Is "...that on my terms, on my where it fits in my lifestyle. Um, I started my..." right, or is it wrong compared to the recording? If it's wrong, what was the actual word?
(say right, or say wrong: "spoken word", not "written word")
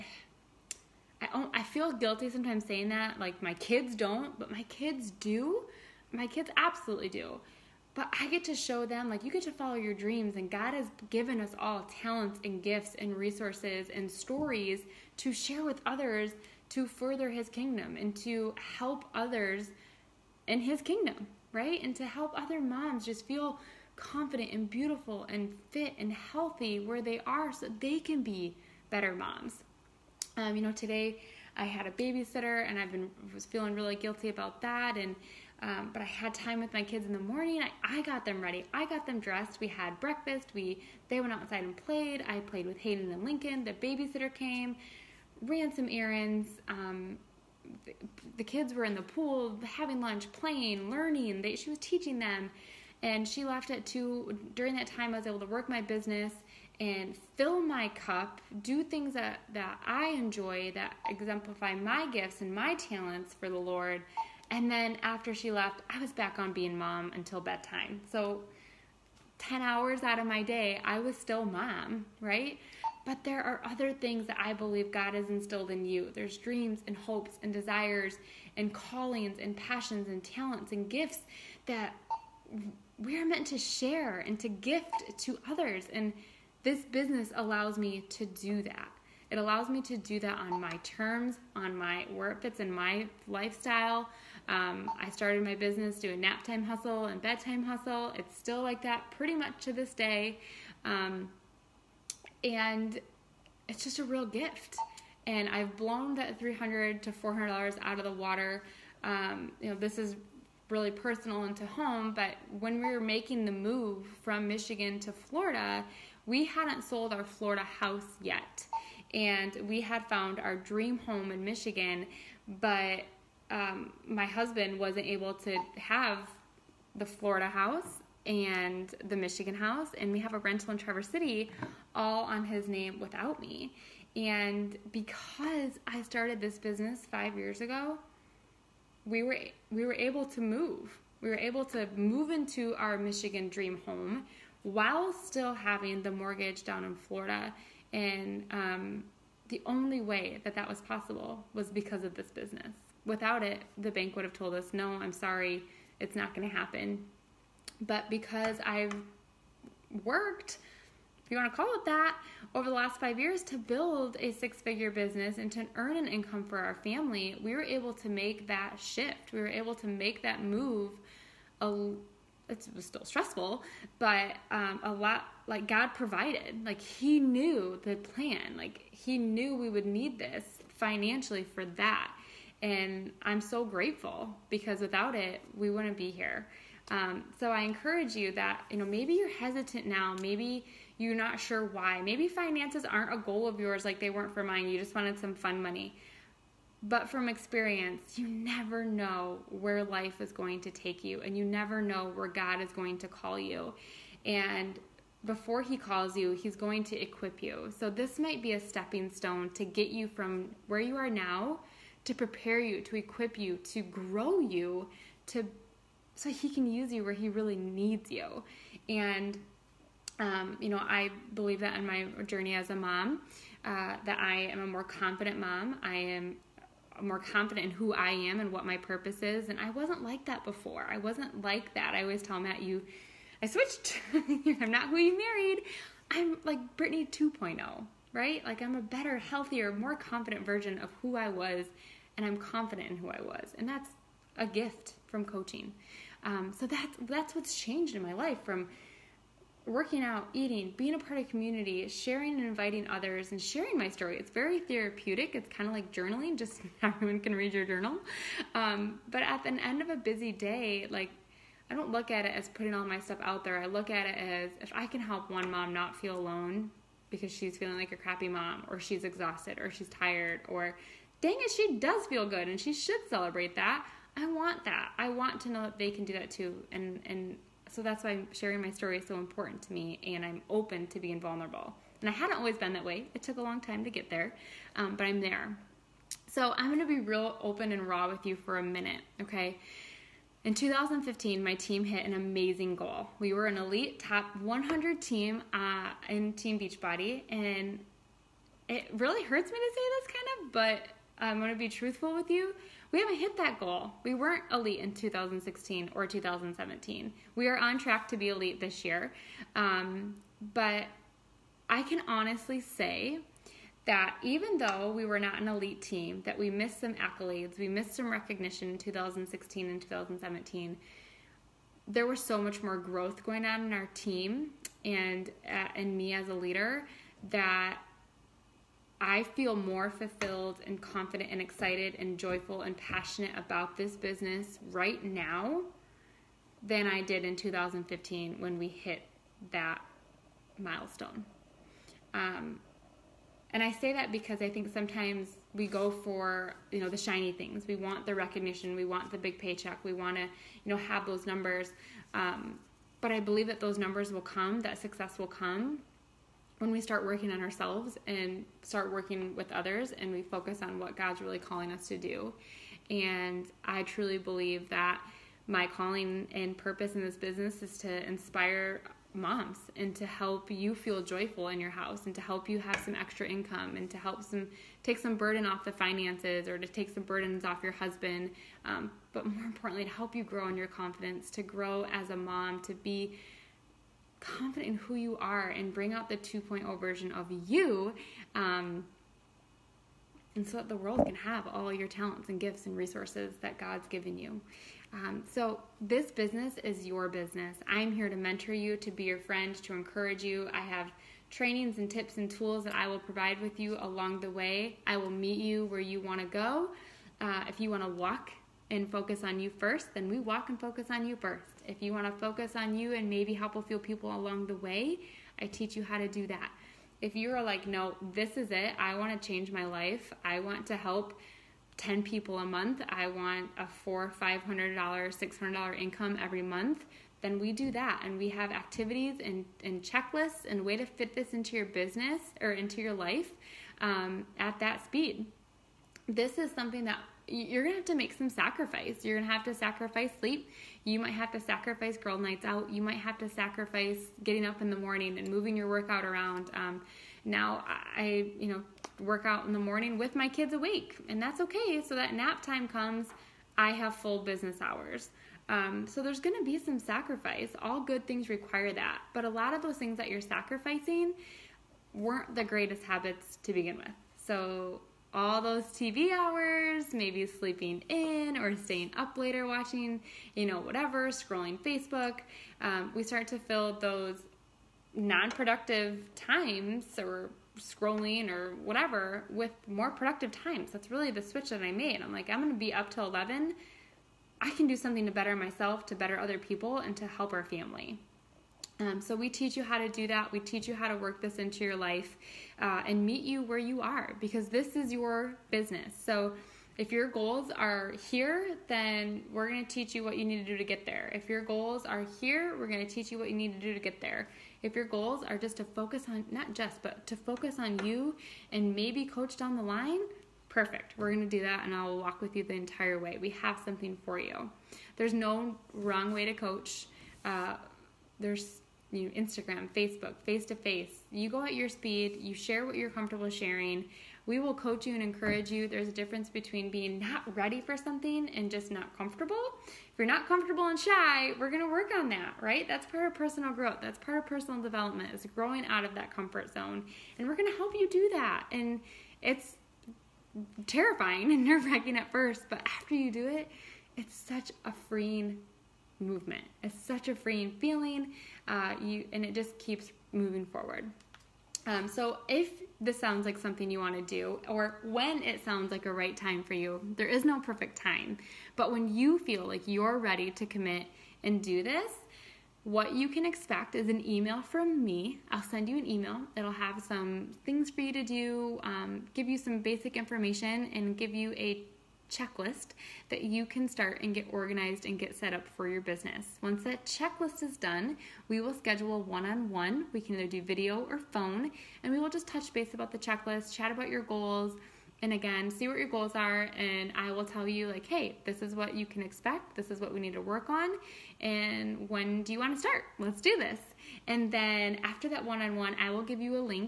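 right.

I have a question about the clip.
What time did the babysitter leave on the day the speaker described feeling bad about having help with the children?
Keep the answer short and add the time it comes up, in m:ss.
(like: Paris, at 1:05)
2, at 0:53.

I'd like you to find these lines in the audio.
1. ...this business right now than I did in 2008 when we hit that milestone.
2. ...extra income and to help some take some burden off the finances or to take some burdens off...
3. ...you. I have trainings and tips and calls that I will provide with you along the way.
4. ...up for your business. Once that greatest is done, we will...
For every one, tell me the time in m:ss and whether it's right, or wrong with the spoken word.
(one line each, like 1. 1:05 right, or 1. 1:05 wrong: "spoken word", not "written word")
1. 5:33 wrong: "2015", not "2008"
2. 6:12 right
3. 6:40 wrong: "tools", not "calls"
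4. 9:35 wrong: "checklist", not "greatest".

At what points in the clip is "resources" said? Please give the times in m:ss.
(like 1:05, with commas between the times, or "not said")
0:13, 6:32.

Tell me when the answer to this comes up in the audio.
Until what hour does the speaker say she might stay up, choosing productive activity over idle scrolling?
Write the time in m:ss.
8:03.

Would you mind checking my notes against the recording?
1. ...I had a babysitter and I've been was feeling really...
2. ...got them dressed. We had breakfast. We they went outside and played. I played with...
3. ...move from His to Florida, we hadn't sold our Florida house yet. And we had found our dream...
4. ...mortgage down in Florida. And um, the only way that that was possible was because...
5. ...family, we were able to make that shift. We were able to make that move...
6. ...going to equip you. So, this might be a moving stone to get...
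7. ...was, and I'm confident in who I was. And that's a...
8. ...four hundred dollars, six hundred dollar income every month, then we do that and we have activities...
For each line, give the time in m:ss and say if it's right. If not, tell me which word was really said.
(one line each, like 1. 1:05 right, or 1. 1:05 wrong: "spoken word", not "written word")
1. 0:31 right
2. 0:38 right
3. 1:53 wrong: "Michigan", not "His"
4. 2:26 right
5. 2:46 right
6. 3:26 wrong: "stepping", not "moving"
7. 4:01 right
8. 7:04 wrong: "five", not "four".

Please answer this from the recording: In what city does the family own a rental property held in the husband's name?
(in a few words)
Traverse City.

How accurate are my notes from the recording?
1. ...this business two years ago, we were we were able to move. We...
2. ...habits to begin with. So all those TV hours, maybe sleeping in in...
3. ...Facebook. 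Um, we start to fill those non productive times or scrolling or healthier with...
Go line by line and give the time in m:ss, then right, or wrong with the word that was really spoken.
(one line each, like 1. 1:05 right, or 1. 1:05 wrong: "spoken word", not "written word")
1. 2:16 wrong: "five", not "two"
2. 7:42 right
3. 7:51 wrong: "whatever", not "healthier".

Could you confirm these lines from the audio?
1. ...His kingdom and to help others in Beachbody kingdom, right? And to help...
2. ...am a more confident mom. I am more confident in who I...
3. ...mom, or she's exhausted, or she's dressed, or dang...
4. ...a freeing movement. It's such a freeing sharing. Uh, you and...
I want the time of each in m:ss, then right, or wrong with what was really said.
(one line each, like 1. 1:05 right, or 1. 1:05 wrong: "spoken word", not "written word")
1. 0:17 wrong: "His", not "Beachbody"
2. 3:44 right
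3. 4:28 wrong: "tired", not "dressed"
4. 9:04 wrong: "feeling", not "sharing".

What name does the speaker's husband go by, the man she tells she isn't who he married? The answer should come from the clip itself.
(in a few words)
Matt.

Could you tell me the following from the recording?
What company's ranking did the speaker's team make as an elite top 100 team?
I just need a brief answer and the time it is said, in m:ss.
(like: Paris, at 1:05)
Team Beachbody, at 4:56.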